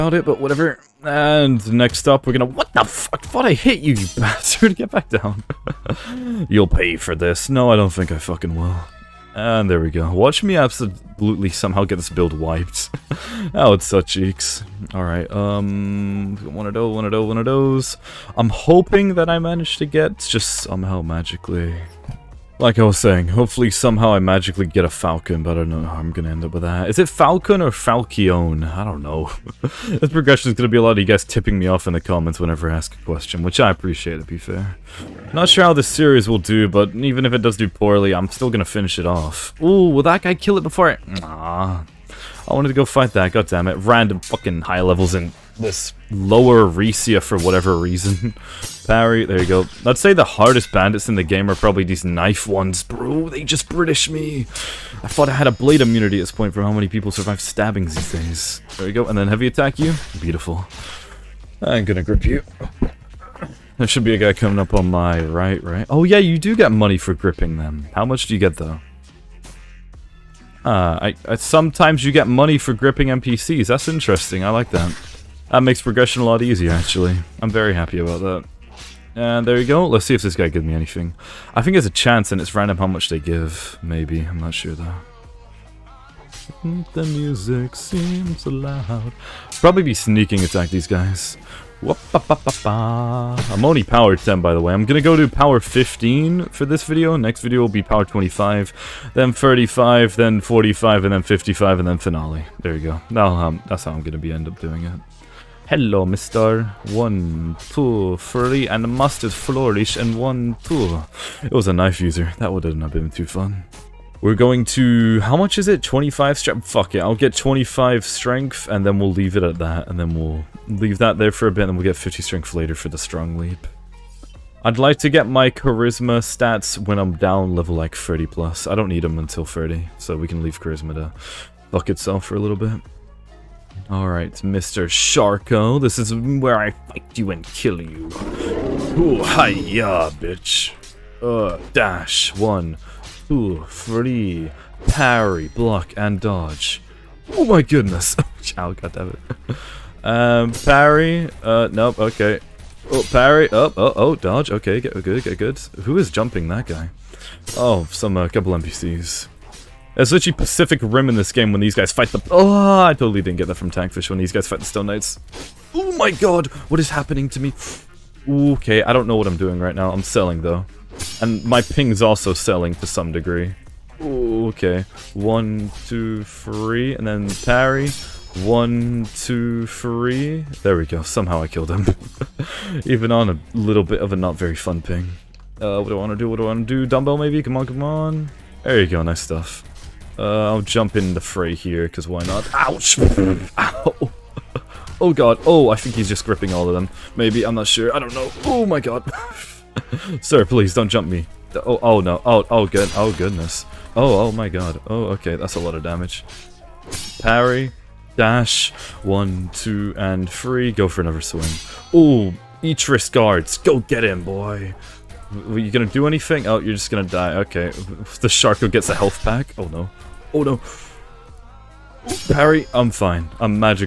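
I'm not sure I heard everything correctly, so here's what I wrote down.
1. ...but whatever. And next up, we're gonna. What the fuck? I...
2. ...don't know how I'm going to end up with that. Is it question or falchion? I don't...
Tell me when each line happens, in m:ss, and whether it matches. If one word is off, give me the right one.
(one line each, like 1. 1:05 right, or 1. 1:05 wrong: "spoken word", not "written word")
1. 0:00 right
2. 0:25 wrong: "falcon", not "question".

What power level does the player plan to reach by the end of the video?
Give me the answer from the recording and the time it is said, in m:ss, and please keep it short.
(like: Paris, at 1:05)
15, at 1:35.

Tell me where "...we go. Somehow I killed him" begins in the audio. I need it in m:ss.
3:00.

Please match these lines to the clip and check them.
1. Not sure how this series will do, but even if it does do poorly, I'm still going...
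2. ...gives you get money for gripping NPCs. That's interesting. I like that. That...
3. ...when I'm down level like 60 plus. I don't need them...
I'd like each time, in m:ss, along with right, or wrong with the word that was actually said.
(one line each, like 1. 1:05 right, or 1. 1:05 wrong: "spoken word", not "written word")
1. 0:35 right
2. 1:11 wrong: "sometimes", not "gives"
3. 2:06 wrong: "30", not "60".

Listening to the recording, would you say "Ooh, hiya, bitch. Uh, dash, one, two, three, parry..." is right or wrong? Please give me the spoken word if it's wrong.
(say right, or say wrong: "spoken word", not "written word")
right.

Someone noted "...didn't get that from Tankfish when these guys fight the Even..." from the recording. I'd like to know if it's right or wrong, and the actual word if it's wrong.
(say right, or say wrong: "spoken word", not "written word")
wrong: "Stone", not "Even".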